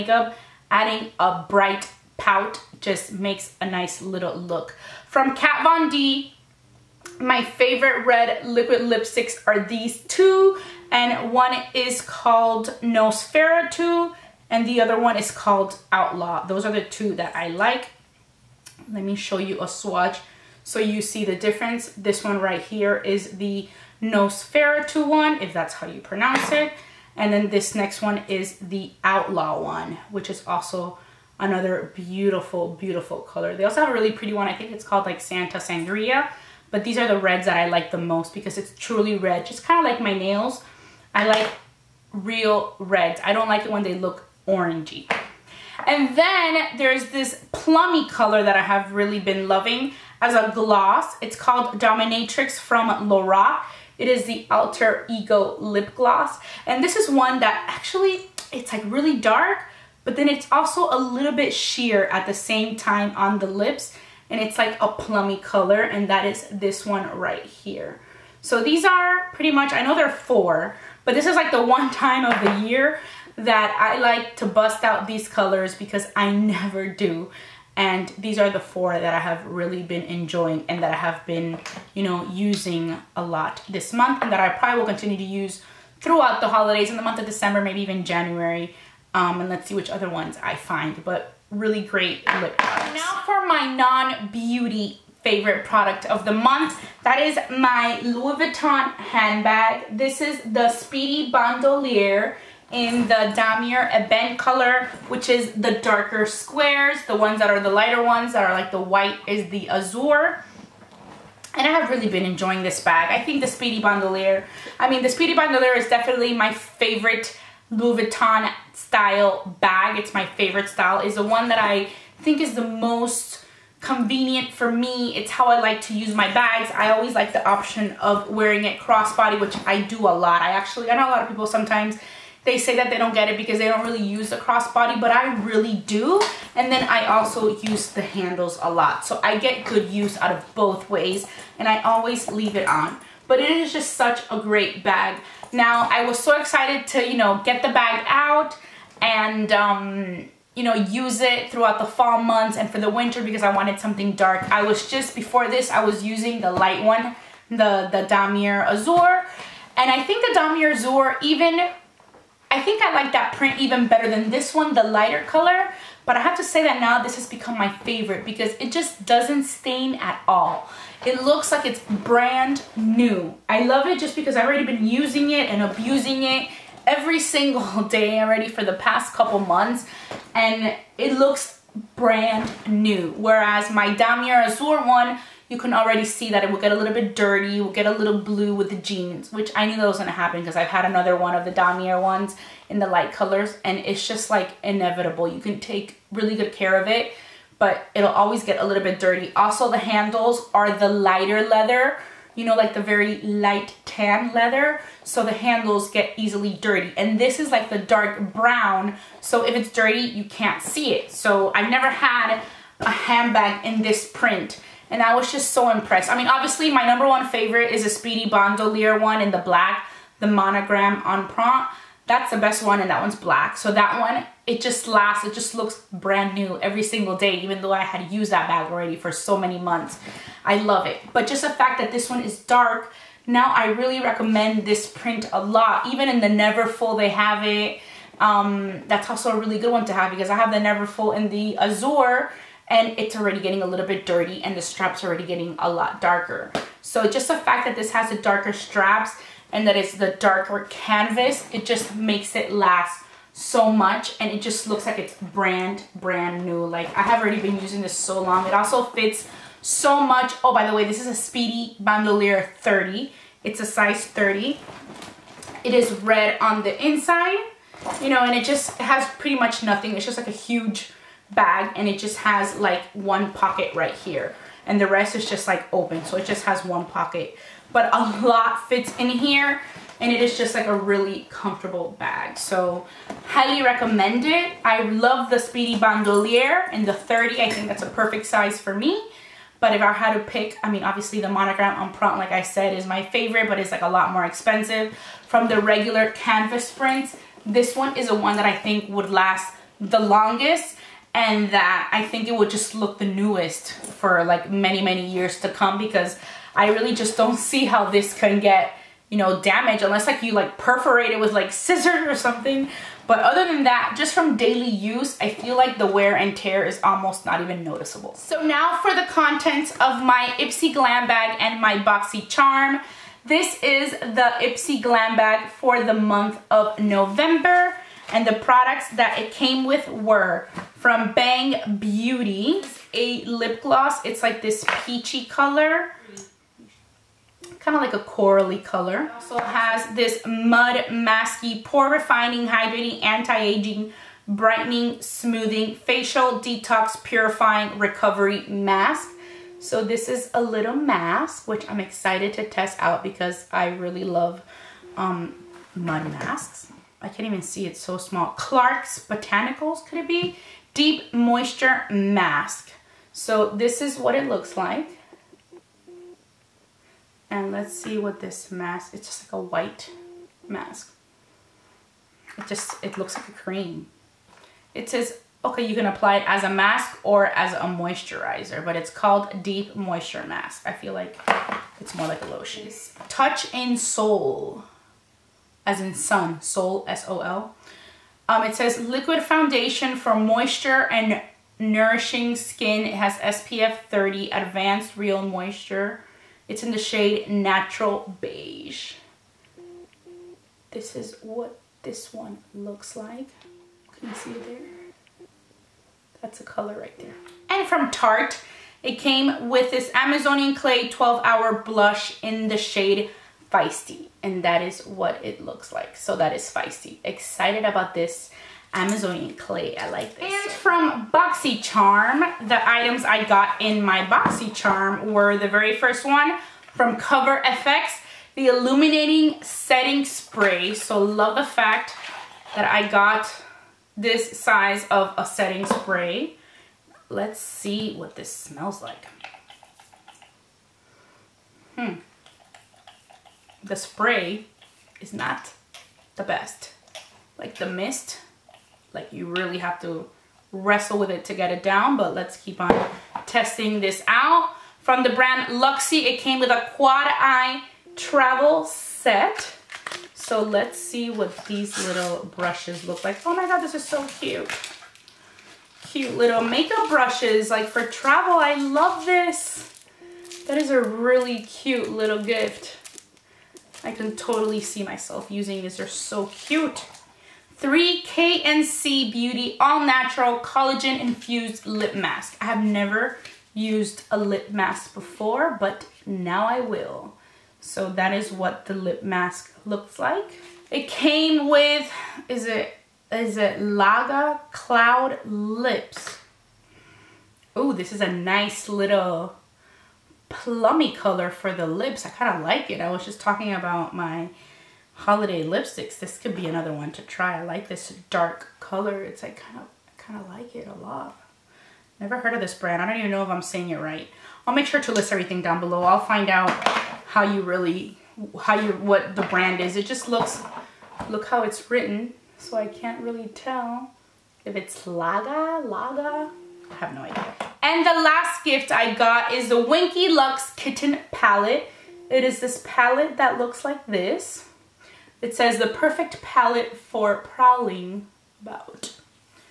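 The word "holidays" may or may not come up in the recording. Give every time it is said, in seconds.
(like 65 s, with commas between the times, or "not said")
86 s, 504 s.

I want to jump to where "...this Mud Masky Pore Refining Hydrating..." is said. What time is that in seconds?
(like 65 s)
339 s.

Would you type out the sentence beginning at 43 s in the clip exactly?
I don't like it when they look orangey.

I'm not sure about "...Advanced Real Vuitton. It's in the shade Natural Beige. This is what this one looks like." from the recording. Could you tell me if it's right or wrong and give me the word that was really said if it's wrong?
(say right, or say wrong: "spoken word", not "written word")
wrong: "Moisture", not "Vuitton".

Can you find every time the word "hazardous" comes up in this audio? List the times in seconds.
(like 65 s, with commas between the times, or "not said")
not said.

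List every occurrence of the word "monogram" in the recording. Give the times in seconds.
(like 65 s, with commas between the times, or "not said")
220 s, 291 s.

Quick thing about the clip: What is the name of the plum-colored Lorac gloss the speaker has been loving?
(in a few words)
Dominatrix.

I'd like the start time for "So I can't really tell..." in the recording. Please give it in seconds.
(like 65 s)
522 s.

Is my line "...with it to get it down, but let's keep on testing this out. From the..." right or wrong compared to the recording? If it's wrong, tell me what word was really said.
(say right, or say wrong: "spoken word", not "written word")
right.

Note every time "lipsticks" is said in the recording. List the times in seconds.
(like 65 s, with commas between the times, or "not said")
8 s, 505 s.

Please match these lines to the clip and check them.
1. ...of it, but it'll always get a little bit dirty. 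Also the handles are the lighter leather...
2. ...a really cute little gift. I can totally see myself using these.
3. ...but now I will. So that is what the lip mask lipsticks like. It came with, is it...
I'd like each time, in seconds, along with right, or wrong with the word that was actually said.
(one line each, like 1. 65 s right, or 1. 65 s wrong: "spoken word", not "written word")
1. 196 s right
2. 470 s right
3. 485 s wrong: "looks", not "lipsticks".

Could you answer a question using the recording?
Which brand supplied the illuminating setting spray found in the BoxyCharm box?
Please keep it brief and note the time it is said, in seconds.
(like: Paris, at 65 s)
Cover FX, at 426 s.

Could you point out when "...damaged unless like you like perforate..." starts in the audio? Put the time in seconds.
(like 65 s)
309 s.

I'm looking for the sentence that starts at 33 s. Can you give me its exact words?
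They also have a really pretty one.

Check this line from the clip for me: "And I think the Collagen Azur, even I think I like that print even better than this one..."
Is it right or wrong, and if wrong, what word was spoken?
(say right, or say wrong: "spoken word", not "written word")
wrong: "Damier", not "Collagen".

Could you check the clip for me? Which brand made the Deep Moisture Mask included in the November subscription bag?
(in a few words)
Clark's Botanicals.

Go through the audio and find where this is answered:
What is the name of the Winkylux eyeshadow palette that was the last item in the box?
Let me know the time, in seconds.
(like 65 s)
530 s.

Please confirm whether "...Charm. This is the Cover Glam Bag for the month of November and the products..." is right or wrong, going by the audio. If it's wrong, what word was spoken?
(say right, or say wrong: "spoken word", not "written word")
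wrong: "Ipsy", not "Cover".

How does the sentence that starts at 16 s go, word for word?
Those are the two that I like.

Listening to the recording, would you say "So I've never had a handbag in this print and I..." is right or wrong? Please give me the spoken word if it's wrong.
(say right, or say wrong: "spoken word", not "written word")
right.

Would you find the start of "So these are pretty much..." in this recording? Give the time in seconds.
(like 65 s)
68 s.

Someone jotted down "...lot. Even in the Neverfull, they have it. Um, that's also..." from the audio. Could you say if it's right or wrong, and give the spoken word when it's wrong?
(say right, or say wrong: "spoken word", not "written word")
right.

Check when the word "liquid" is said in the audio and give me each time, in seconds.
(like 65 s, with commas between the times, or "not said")
8 s, 388 s.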